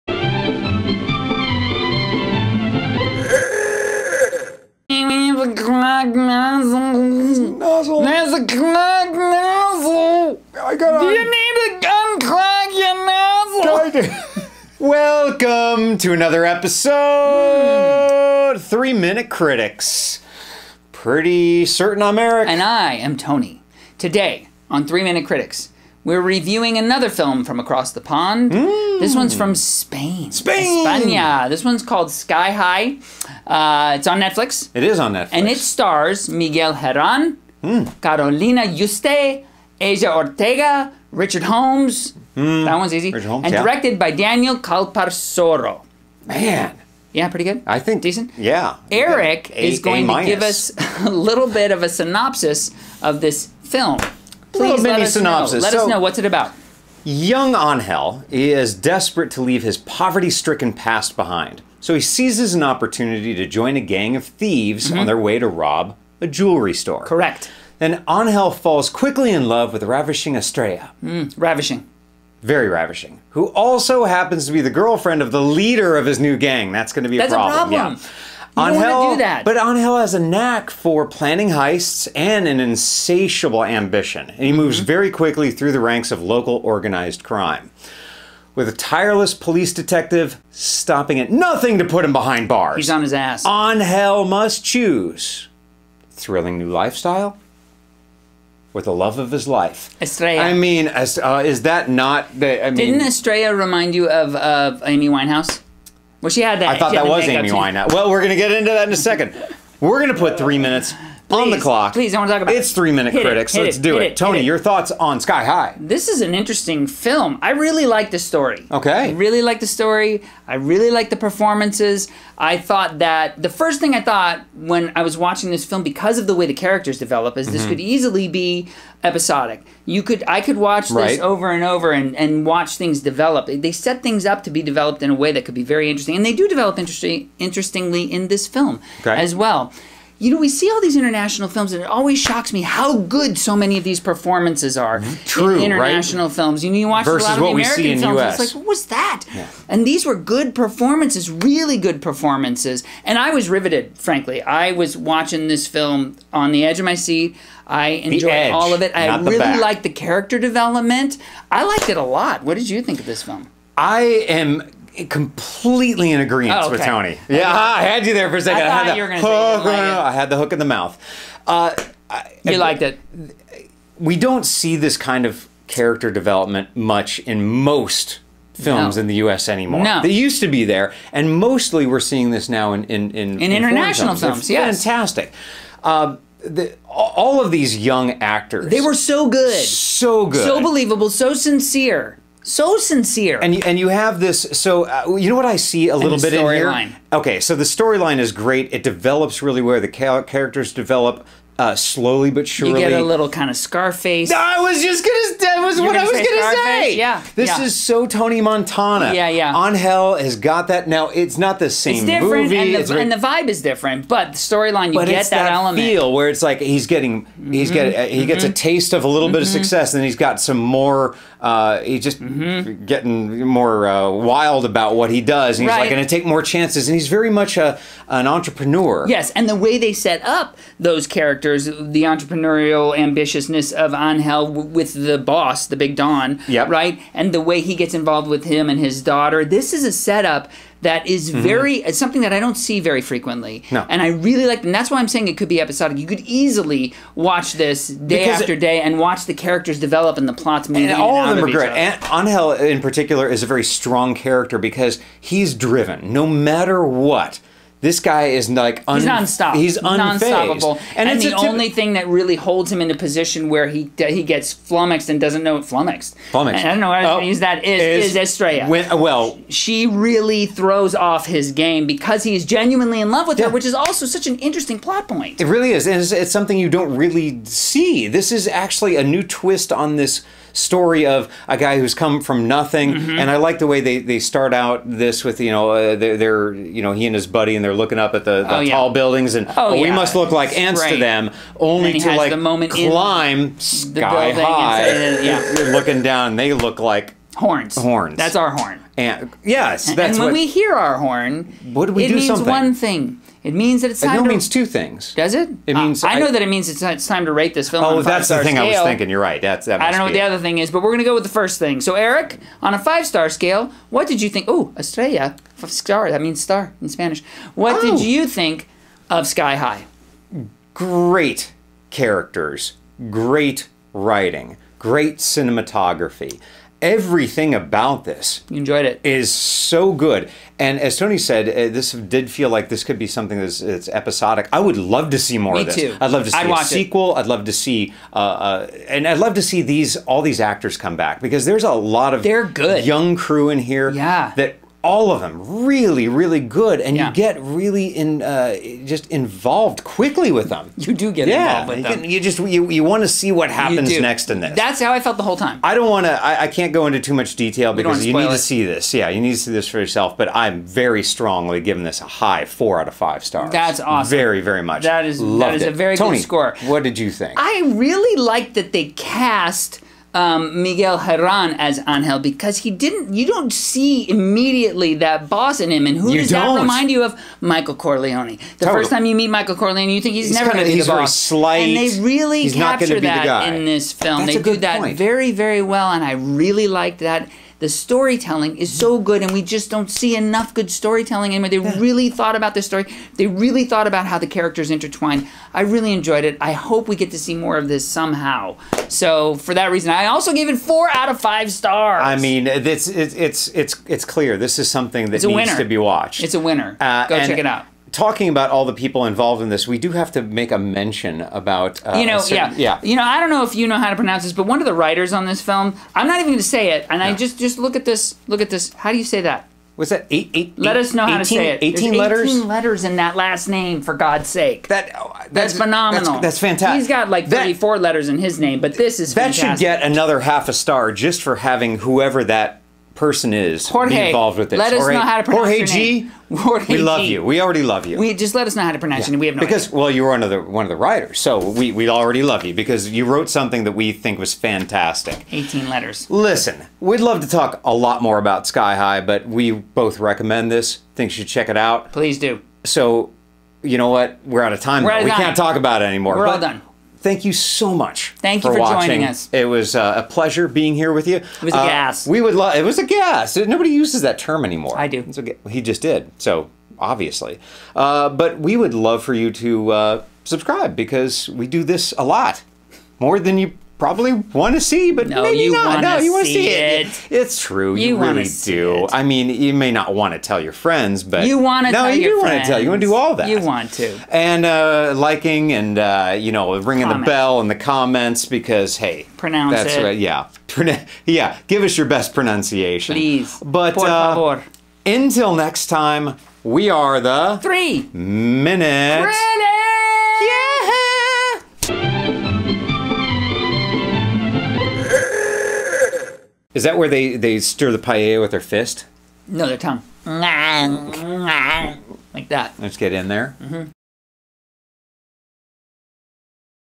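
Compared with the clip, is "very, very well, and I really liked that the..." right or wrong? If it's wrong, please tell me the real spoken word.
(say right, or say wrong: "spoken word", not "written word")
right.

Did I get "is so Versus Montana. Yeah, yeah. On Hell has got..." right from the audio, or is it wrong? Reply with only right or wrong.
wrong.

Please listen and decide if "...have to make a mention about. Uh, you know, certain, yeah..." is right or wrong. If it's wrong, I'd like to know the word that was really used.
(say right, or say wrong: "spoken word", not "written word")
right.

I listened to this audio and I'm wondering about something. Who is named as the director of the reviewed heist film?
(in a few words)
Daniel Calparsoro.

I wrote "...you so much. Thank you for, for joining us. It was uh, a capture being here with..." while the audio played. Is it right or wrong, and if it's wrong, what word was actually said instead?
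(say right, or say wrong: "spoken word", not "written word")
wrong: "pleasure", not "capture".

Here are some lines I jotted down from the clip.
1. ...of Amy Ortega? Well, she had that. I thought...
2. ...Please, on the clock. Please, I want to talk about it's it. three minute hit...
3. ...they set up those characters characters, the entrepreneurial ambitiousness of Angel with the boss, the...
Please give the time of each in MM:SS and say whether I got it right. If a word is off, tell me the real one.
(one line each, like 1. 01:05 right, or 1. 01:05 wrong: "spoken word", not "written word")
1. 01:44 wrong: "Winehouse", not "Ortega"
2. 01:51 right
3. 03:49 right.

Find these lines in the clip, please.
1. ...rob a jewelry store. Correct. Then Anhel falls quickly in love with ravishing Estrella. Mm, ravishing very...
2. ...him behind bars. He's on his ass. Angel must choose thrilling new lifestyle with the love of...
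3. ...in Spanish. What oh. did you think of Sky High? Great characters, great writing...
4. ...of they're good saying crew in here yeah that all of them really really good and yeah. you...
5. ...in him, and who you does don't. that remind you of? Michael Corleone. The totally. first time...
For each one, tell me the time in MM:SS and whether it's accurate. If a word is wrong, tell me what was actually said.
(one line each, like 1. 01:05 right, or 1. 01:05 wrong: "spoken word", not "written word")
1. 01:05 right
2. 01:32 right
3. 05:16 right
4. 05:42 wrong: "young", not "saying"
5. 06:15 right.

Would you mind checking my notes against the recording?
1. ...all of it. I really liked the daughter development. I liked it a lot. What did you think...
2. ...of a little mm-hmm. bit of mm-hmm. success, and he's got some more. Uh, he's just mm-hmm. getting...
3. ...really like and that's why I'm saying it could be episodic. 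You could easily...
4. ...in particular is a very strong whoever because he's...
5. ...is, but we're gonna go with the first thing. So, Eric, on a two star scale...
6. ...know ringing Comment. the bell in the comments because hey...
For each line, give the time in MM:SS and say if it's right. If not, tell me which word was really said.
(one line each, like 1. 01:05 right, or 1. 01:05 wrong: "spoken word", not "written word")
1. 02:38 wrong: "character", not "daughter"
2. 03:38 right
3. 04:04 right
4. 04:12 wrong: "character", not "whoever"
5. 05:10 wrong: "five", not "two"
6. 08:06 right.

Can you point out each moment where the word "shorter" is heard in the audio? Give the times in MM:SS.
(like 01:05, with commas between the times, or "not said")
not said.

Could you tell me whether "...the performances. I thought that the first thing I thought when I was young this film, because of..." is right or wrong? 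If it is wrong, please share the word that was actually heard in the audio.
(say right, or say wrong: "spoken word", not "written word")
wrong: "watching", not "young".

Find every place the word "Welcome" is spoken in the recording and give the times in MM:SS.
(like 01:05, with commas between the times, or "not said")
00:14.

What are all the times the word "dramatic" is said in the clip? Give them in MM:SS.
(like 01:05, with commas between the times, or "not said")
not said.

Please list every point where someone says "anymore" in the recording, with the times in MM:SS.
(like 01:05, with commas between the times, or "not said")
02:59, 06:31, 07:35, 07:44.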